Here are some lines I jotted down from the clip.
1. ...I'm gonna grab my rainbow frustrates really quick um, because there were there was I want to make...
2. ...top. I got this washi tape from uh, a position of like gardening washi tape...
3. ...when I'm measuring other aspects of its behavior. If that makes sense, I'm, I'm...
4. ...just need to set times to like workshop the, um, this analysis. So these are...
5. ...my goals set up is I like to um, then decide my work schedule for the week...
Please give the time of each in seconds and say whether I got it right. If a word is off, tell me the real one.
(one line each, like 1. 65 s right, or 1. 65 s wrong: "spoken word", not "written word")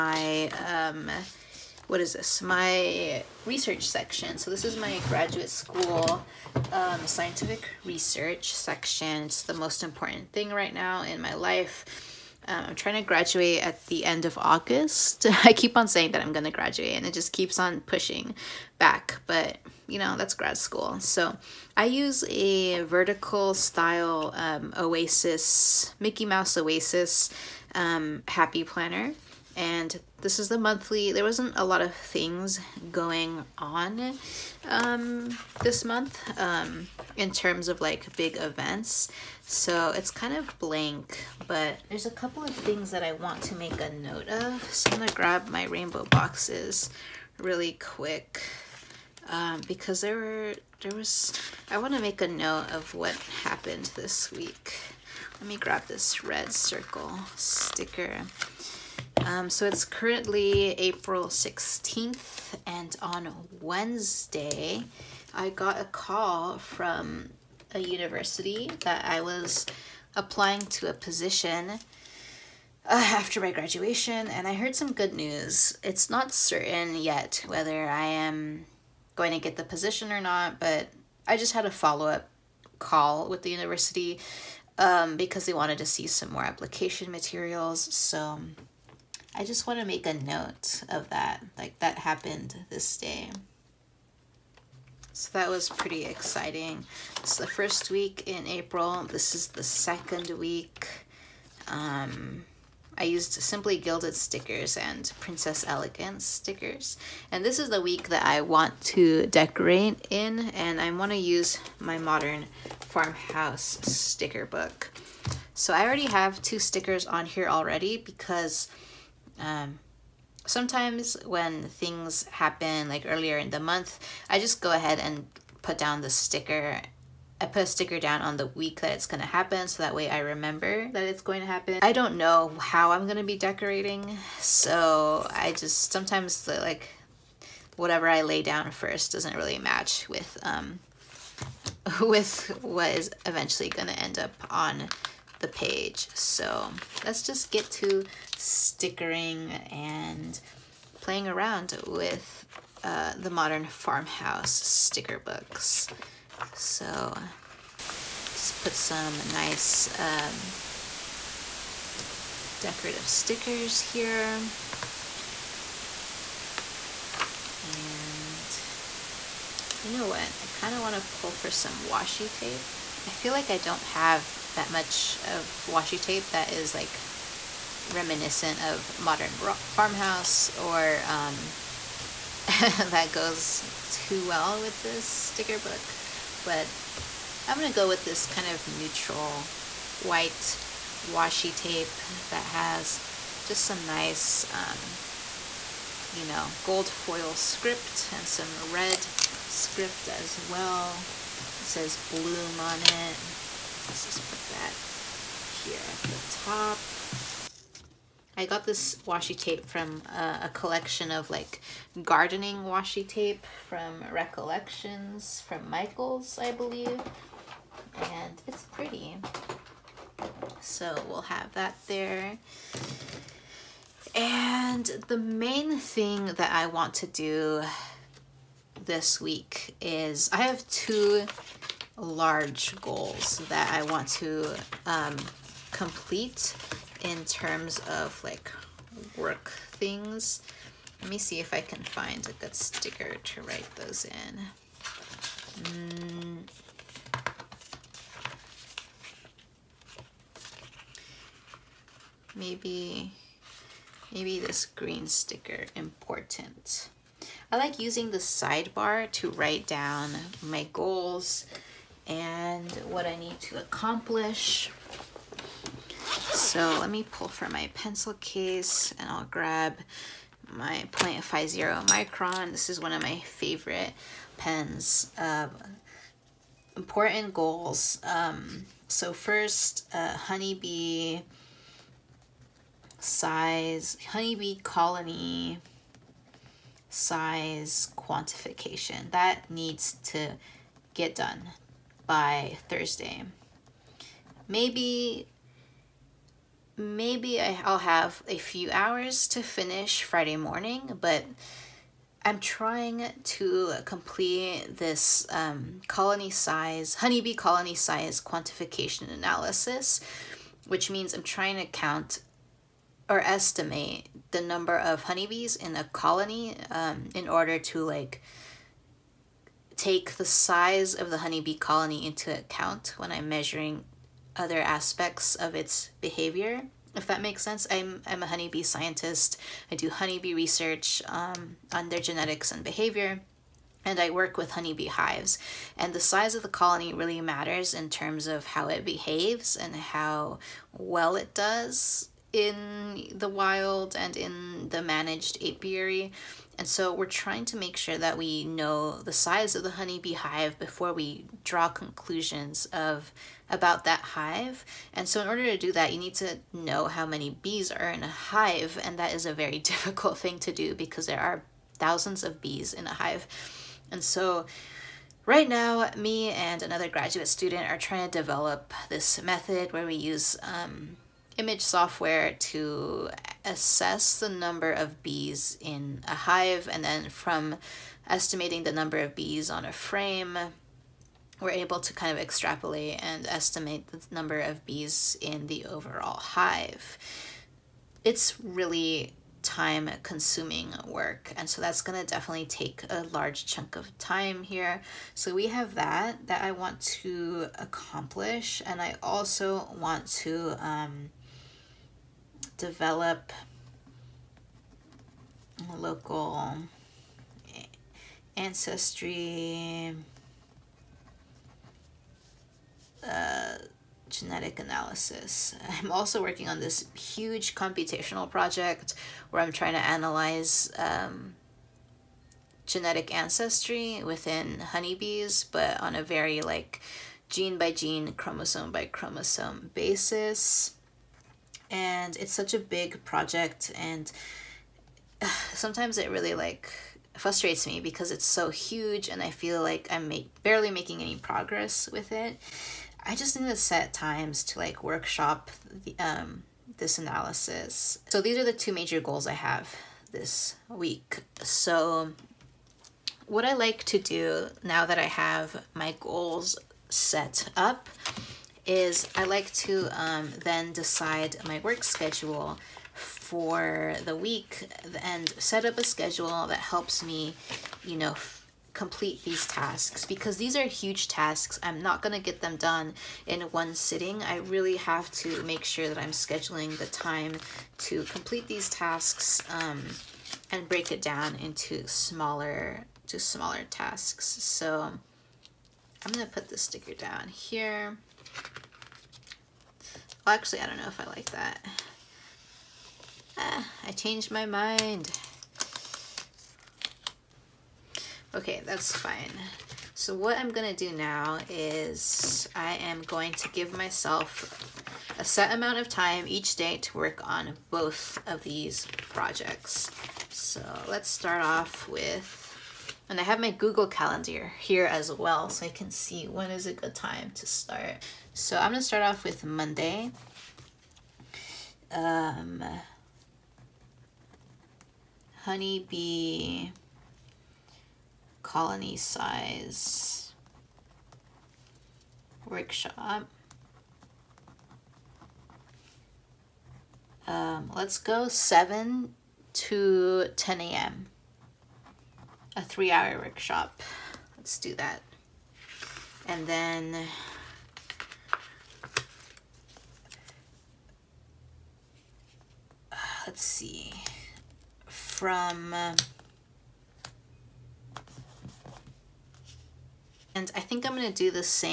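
1. 44 s wrong: "boxes", not "frustrates"
2. 206 s wrong: "collection", not "position"
3. 322 s right
4. 443 s right
5. 455 s right.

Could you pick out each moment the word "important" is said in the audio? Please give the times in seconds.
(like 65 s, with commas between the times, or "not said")
9 s, 255 s, 276 s.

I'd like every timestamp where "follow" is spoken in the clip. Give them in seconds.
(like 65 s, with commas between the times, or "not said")
81 s.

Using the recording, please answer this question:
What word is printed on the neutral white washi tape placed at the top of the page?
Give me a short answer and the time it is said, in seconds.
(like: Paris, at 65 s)
bloom, at 201 s.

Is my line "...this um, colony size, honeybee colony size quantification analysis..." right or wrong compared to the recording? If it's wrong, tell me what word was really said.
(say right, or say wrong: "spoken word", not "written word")
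right.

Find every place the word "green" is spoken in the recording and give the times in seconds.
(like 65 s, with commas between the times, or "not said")
254 s.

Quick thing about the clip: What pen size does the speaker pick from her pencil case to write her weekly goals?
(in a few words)
0.50 micron.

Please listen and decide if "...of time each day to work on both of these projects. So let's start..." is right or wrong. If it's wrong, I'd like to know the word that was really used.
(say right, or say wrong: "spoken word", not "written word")
right.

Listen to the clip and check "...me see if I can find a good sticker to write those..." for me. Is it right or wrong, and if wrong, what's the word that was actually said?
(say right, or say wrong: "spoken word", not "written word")
right.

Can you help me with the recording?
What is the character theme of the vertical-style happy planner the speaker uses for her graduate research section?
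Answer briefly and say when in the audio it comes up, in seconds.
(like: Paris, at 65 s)
Mickey Mouse Oasis, at 25 s.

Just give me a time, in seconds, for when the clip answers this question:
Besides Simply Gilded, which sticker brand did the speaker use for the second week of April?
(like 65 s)
105 s.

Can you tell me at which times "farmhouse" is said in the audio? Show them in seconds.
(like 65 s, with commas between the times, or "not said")
112 s, 153 s, 179 s.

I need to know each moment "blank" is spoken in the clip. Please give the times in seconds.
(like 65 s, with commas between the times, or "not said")
40 s.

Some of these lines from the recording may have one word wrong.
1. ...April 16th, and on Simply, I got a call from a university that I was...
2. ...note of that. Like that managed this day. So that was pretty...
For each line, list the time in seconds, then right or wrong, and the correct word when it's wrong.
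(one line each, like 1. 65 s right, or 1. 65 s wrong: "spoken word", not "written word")
1. 60 s wrong: "Wednesday", not "Simply"
2. 90 s wrong: "happened", not "managed".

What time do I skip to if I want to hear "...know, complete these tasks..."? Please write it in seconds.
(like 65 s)
467 s.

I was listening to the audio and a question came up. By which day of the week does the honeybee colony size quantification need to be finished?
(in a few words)
Thursday.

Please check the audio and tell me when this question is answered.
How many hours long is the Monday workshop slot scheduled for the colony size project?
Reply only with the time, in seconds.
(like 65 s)
542 s.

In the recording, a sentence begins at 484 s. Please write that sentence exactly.
So I'm going to put the sticker down here.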